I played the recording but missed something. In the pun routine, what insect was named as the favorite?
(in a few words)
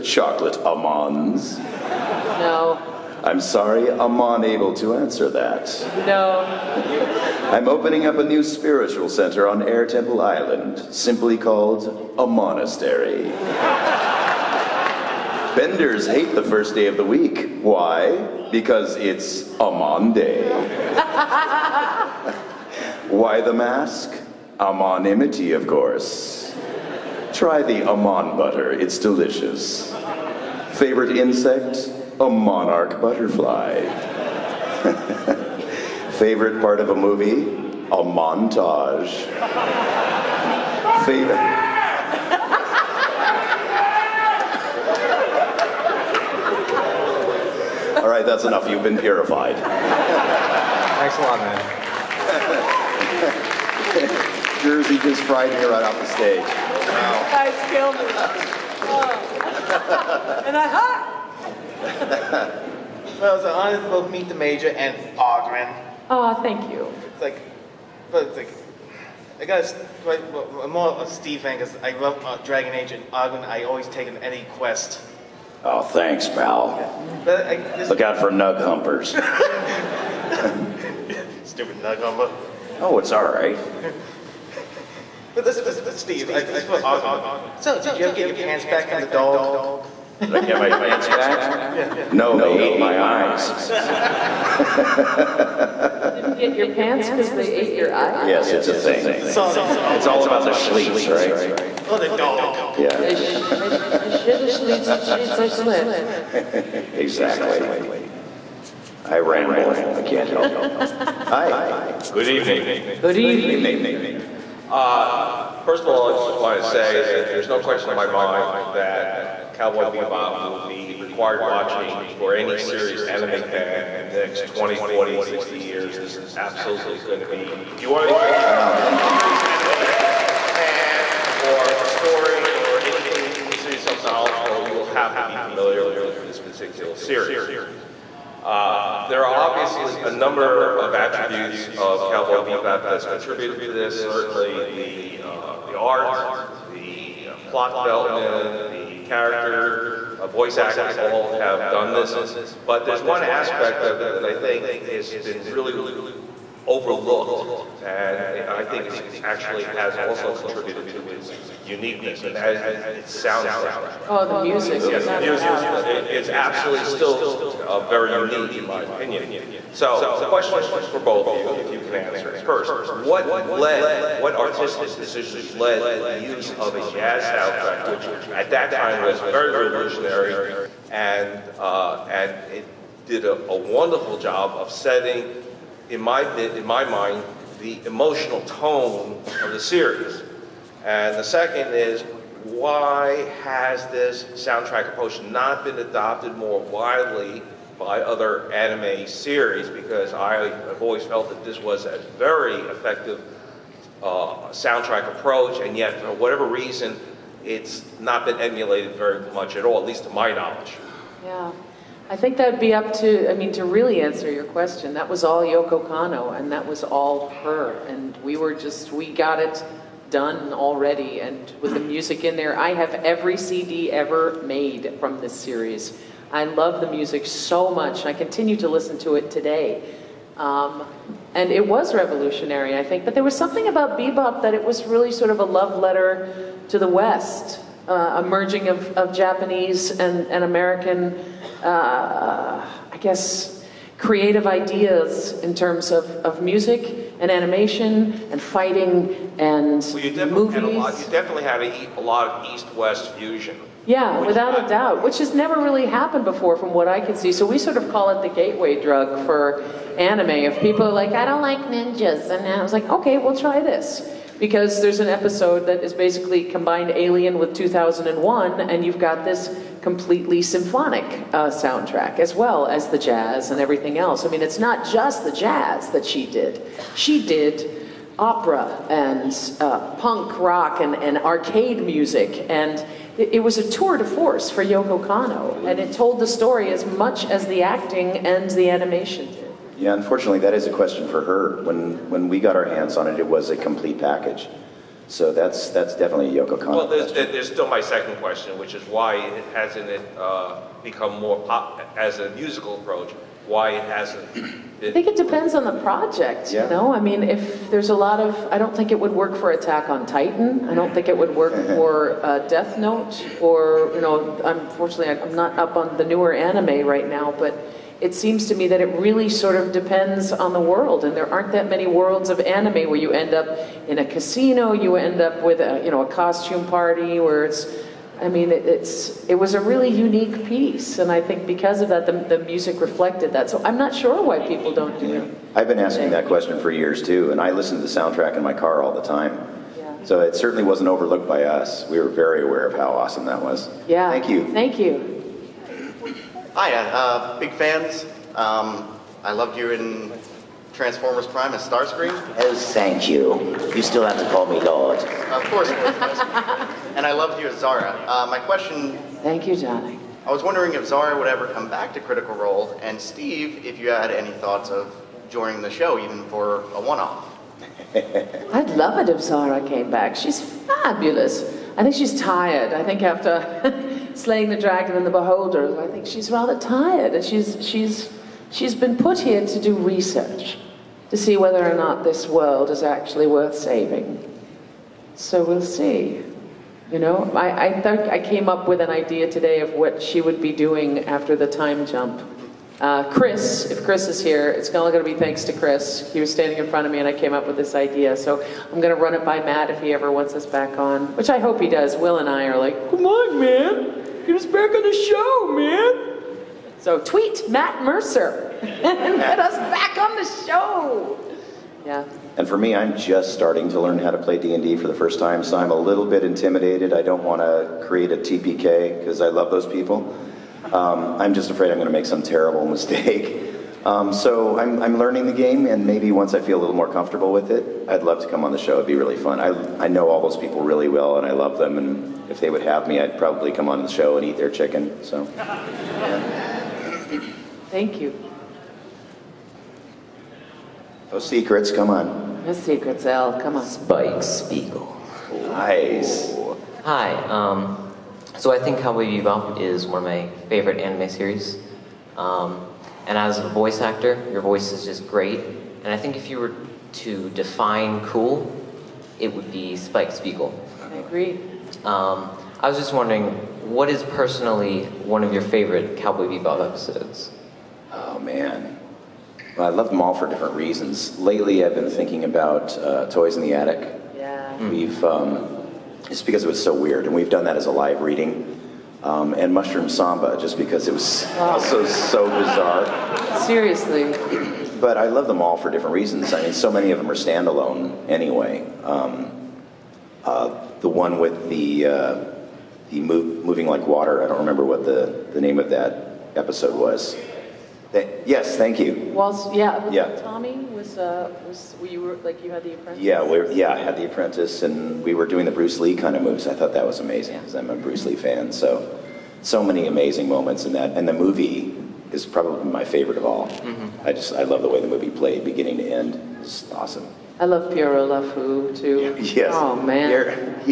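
monarch butterfly.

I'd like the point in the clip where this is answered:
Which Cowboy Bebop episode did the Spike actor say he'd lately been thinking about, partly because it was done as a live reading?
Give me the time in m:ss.
7:53.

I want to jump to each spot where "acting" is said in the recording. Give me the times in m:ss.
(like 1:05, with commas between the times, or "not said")
2:30, 4:47.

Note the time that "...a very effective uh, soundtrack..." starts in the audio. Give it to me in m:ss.
3:21.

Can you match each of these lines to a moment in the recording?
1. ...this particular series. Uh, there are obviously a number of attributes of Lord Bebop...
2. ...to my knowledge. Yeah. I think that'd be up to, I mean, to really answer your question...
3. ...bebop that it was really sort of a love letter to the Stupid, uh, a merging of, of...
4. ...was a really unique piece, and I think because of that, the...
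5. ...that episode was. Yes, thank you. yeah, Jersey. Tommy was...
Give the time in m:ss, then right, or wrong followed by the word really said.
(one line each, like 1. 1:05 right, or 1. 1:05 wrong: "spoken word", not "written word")
1. 2:16 wrong: "Cowboy", not "Lord"
2. 3:30 right
3. 3:53 wrong: "West", not "Stupid"
4. 5:29 right
5. 8:15 wrong: "Yeah", not "Jersey".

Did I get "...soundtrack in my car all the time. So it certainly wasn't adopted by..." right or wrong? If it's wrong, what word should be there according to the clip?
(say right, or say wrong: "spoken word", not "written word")
wrong: "overlooked", not "adopted".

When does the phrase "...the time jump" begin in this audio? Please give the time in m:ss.
6:31.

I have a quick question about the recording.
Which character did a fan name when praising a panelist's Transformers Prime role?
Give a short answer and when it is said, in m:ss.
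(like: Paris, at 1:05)
Starscream, at 5:51.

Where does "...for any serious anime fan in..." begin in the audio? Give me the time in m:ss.
2:02.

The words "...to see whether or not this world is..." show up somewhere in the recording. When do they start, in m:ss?
6:21.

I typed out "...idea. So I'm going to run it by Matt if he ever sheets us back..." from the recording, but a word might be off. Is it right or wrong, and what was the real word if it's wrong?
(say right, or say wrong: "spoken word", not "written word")
wrong: "wants", not "sheets".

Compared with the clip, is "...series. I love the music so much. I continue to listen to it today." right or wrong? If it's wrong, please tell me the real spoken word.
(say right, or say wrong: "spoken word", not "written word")
right.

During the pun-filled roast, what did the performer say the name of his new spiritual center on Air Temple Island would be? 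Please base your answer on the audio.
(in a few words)
a monastery.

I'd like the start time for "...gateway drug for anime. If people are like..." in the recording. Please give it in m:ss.
4:18.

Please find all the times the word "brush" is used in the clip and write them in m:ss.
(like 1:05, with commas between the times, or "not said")
not said.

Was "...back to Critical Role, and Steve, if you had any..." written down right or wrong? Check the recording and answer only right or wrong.
right.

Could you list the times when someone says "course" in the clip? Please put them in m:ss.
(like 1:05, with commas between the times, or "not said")
0:25, 5:55.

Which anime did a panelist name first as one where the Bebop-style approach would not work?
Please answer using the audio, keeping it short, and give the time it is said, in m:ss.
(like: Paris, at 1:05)
Attack on Titan, at 5:09.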